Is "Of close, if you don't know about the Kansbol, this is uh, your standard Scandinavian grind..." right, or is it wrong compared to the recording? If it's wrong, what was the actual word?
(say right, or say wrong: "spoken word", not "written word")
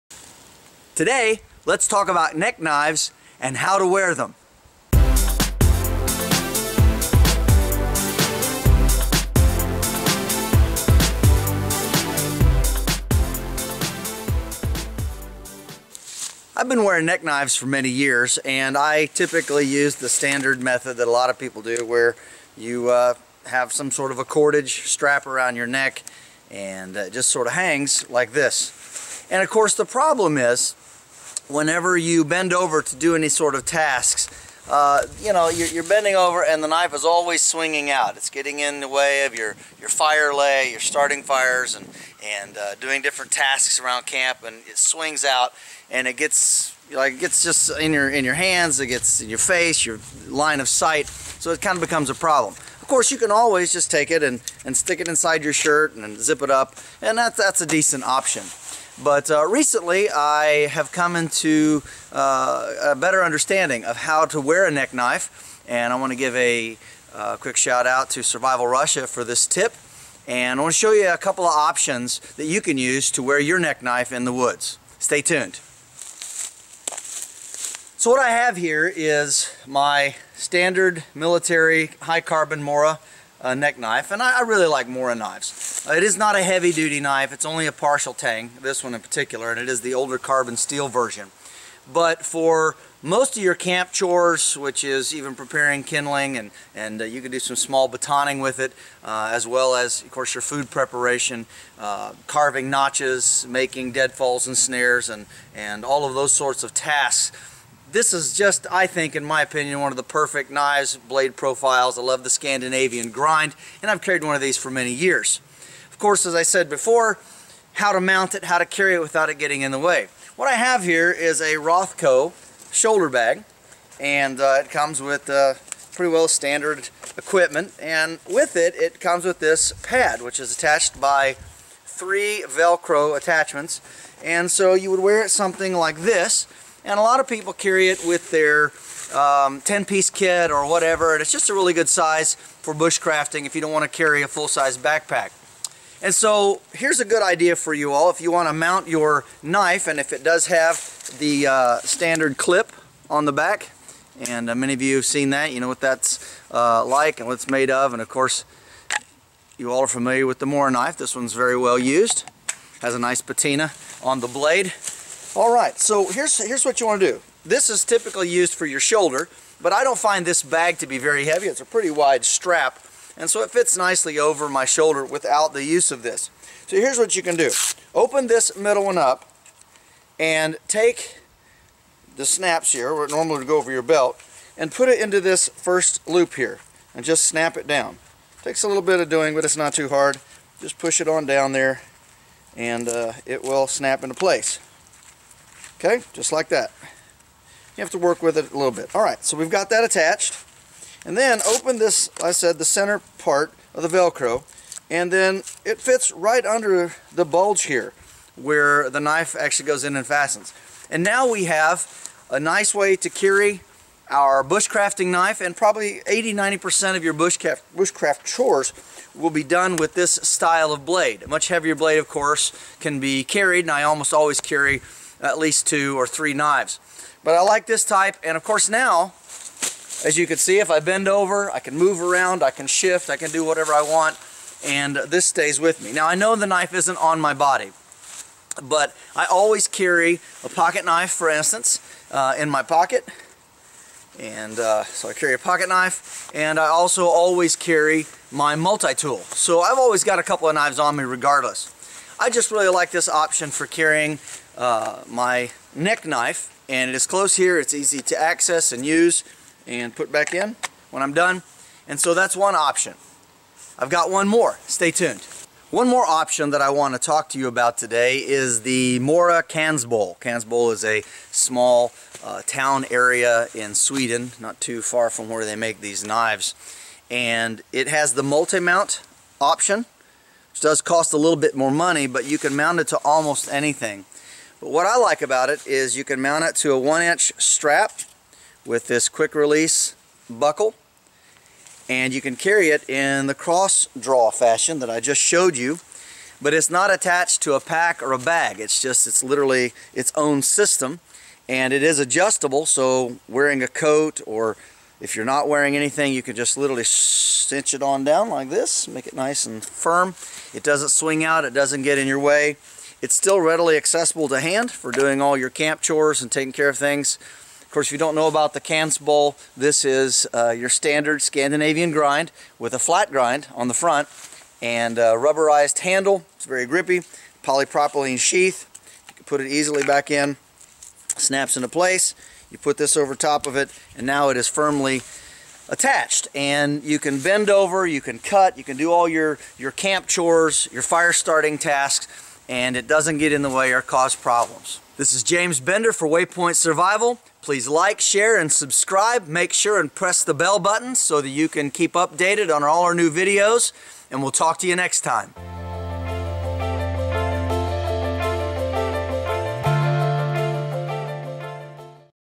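wrong: "course", not "close".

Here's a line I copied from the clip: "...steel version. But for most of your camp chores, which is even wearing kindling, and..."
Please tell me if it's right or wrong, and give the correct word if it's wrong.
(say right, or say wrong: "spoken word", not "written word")
wrong: "preparing", not "wearing".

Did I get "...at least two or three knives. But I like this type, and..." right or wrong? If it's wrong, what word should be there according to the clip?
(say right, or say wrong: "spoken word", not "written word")
right.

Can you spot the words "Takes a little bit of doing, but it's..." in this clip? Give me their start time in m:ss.
3:08.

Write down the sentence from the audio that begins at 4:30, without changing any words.
Kansbol is a small uh, town area in Sweden, not too far from where they make these knives.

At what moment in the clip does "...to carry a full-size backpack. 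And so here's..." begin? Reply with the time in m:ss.
2:23.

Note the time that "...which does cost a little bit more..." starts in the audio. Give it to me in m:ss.
4:40.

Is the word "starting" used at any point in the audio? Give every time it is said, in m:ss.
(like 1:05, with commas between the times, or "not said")
0:40, 5:41.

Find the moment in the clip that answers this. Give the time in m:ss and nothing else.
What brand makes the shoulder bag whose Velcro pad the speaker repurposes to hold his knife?
2:01.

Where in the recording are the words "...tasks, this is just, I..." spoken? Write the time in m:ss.
1:46.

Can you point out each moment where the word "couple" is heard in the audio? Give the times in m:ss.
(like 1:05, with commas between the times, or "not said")
1:11, 4:10.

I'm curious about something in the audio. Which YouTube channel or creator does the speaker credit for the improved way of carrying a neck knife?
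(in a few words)
Survival Russia.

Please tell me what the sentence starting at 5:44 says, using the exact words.
This is James Bender for Waypoint Survival.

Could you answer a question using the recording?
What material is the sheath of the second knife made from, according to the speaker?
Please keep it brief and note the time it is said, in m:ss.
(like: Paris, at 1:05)
Polypropylene, at 5:27.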